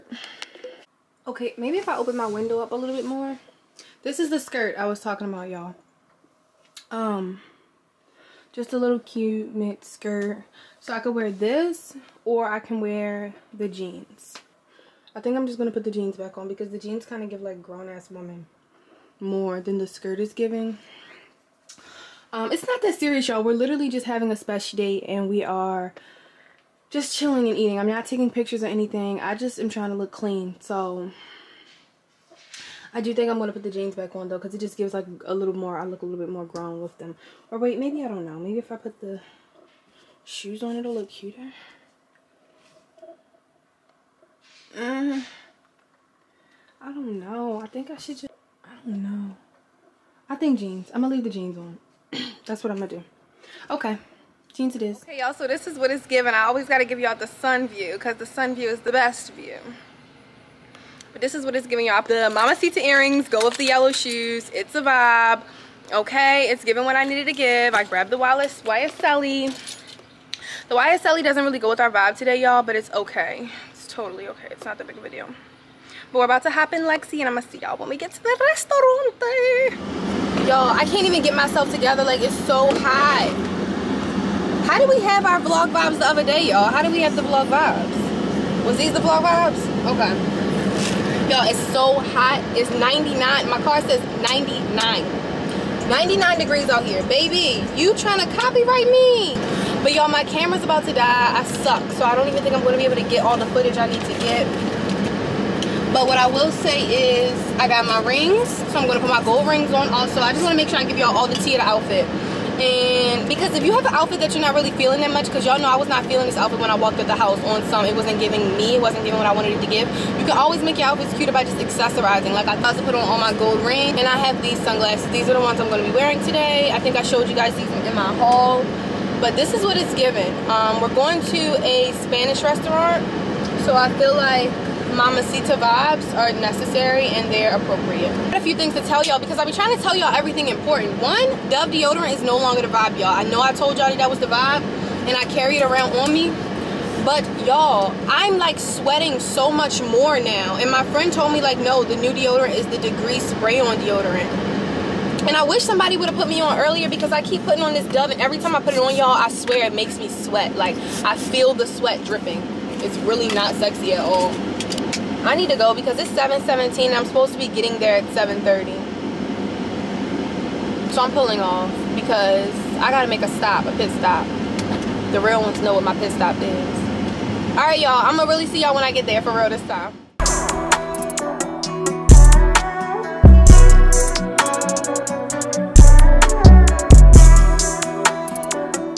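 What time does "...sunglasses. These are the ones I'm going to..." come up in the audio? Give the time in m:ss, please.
2:04.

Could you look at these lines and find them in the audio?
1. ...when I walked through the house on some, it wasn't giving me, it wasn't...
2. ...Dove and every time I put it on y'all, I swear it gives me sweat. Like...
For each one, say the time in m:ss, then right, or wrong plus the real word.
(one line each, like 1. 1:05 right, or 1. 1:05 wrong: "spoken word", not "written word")
1. 1:56 right
2. 2:37 wrong: "makes", not "gives".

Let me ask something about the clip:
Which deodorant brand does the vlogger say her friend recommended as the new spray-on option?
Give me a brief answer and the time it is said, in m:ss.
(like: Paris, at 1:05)
Degree, at 2:32.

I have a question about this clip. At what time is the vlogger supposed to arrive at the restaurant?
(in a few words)
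7:30.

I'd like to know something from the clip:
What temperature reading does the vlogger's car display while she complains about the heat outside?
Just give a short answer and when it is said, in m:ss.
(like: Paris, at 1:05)
99 degrees, at 1:35.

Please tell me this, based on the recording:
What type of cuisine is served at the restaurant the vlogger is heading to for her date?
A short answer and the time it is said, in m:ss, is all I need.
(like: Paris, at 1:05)
Spanish, at 2:12.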